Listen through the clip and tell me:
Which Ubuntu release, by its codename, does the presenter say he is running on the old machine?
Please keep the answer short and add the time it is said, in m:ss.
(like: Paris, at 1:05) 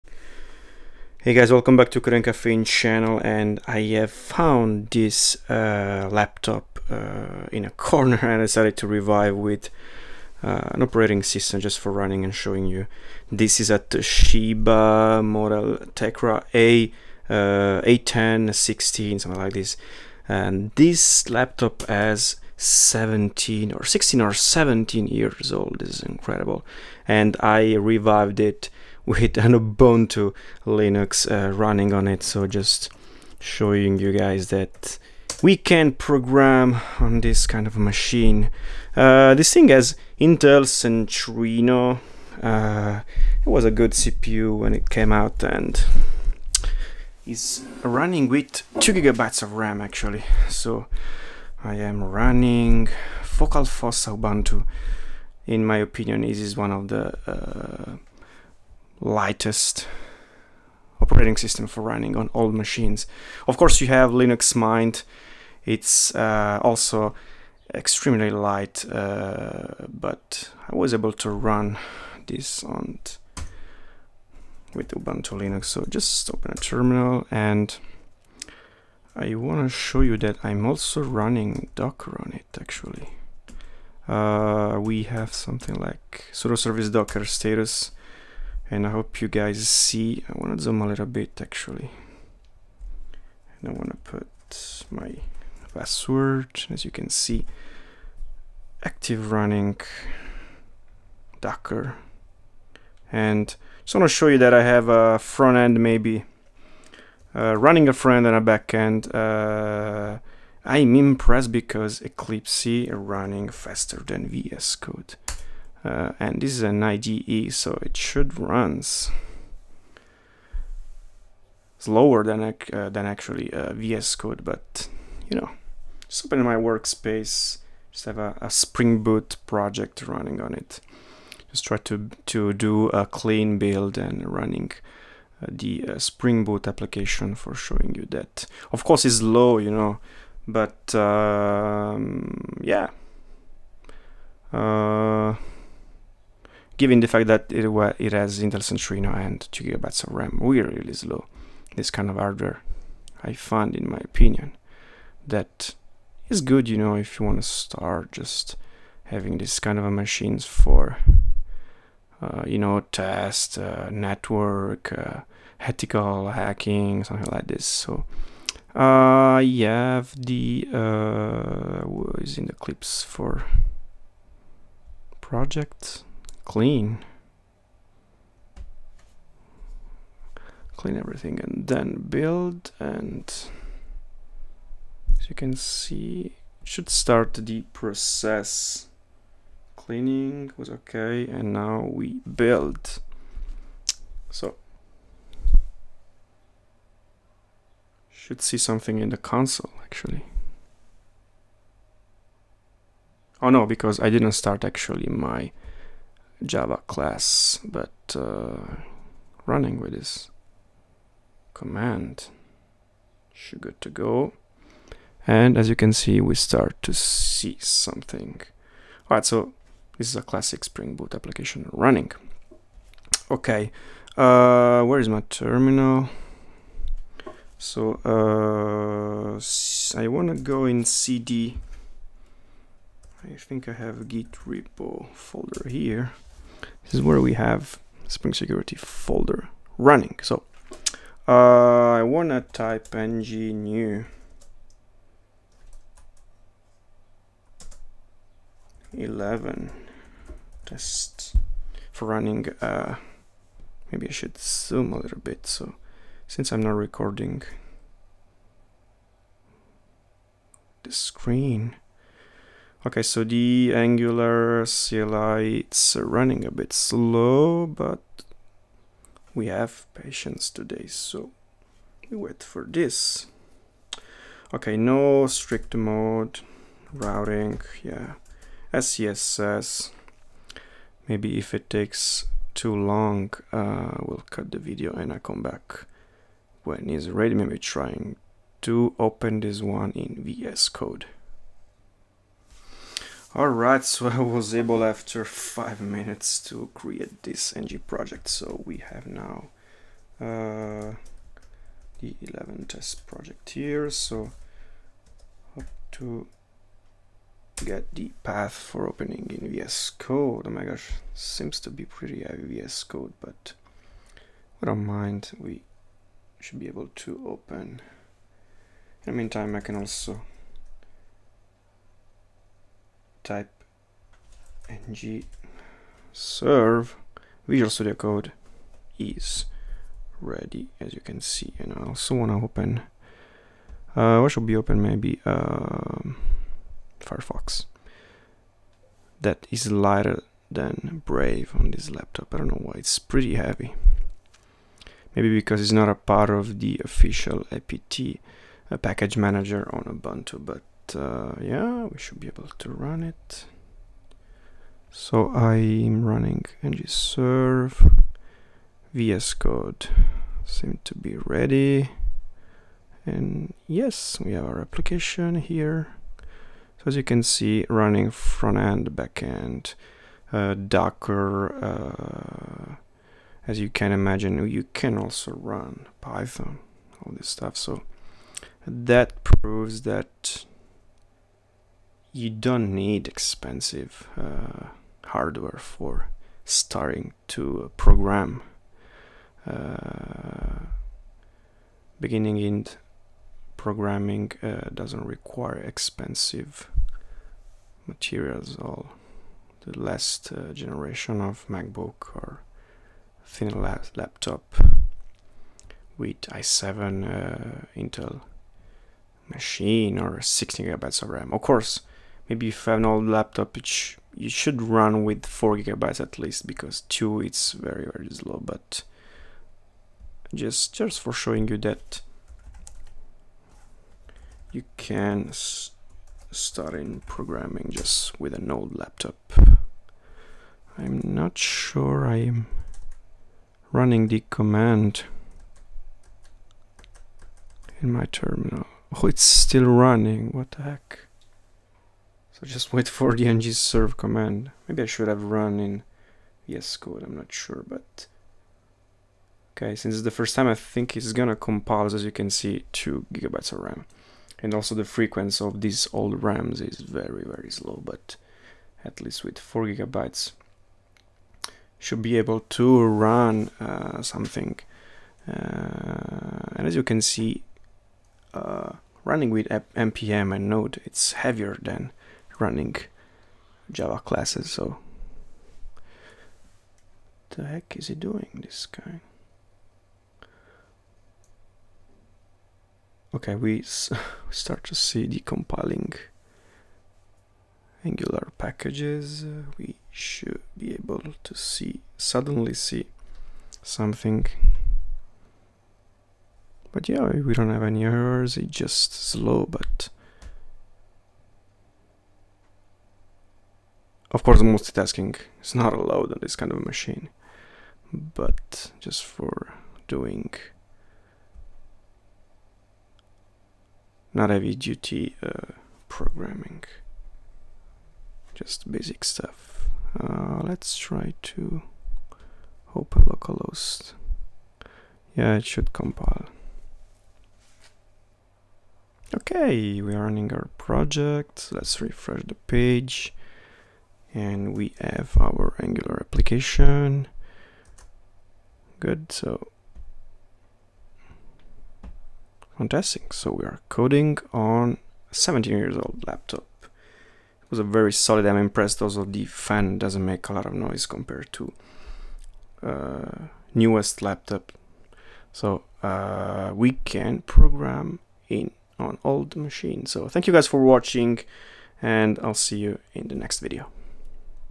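Focal Fossa, at 0:53.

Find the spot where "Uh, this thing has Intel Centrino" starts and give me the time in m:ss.
0:38.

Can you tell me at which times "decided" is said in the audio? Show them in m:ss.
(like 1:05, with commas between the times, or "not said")
0:08.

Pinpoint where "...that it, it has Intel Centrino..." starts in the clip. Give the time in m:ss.
2:27.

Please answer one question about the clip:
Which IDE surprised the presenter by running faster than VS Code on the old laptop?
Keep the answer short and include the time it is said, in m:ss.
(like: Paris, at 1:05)
Eclipse, at 1:52.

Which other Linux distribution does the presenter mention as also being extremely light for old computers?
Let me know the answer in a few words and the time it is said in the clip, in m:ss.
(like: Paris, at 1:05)
Linux Mint, at 1:04.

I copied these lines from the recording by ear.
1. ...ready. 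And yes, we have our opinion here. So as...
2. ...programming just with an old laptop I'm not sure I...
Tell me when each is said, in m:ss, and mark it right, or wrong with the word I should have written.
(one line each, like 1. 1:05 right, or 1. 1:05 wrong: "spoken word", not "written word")
1. 6:01 wrong: "application", not "opinion"
2. 7:07 right.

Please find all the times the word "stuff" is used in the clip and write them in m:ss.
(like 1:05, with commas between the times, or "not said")
6:17, 8:39.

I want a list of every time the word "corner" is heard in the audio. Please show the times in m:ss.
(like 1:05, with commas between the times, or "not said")
0:07.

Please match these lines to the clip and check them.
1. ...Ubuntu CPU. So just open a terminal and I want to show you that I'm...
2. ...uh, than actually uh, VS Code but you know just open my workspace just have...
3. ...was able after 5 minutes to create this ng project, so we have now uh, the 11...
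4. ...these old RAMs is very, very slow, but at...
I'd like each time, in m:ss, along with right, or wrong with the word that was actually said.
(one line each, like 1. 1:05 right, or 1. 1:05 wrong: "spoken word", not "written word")
1. 1:14 wrong: "Linux", not "CPU"
2. 2:02 right
3. 4:54 right
4. 7:35 right.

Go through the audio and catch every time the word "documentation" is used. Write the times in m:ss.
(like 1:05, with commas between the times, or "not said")
not said.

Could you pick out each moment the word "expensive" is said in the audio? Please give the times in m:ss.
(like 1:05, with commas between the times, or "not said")
6:23, 6:35.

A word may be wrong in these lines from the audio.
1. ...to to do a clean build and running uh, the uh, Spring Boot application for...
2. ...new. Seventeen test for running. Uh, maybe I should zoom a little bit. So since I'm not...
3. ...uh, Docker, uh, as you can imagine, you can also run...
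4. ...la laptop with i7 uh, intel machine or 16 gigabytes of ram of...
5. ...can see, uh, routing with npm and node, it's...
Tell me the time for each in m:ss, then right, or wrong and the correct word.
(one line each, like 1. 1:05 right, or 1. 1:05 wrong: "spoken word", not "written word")
1. 2:11 right
2. 4:03 wrong: "Eleven", not "Seventeen"
3. 6:10 right
4. 6:43 right
5. 7:46 wrong: "running", not "routing".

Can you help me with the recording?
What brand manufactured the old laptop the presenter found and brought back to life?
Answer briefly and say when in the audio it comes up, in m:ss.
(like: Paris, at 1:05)
Toshiba, at 0:13.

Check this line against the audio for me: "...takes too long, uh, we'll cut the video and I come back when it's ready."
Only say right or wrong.
right.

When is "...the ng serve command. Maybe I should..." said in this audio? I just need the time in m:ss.
7:23.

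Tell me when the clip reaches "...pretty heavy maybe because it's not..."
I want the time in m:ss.
5:42.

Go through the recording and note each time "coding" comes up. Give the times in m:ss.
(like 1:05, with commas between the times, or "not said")
0:02, 9:03.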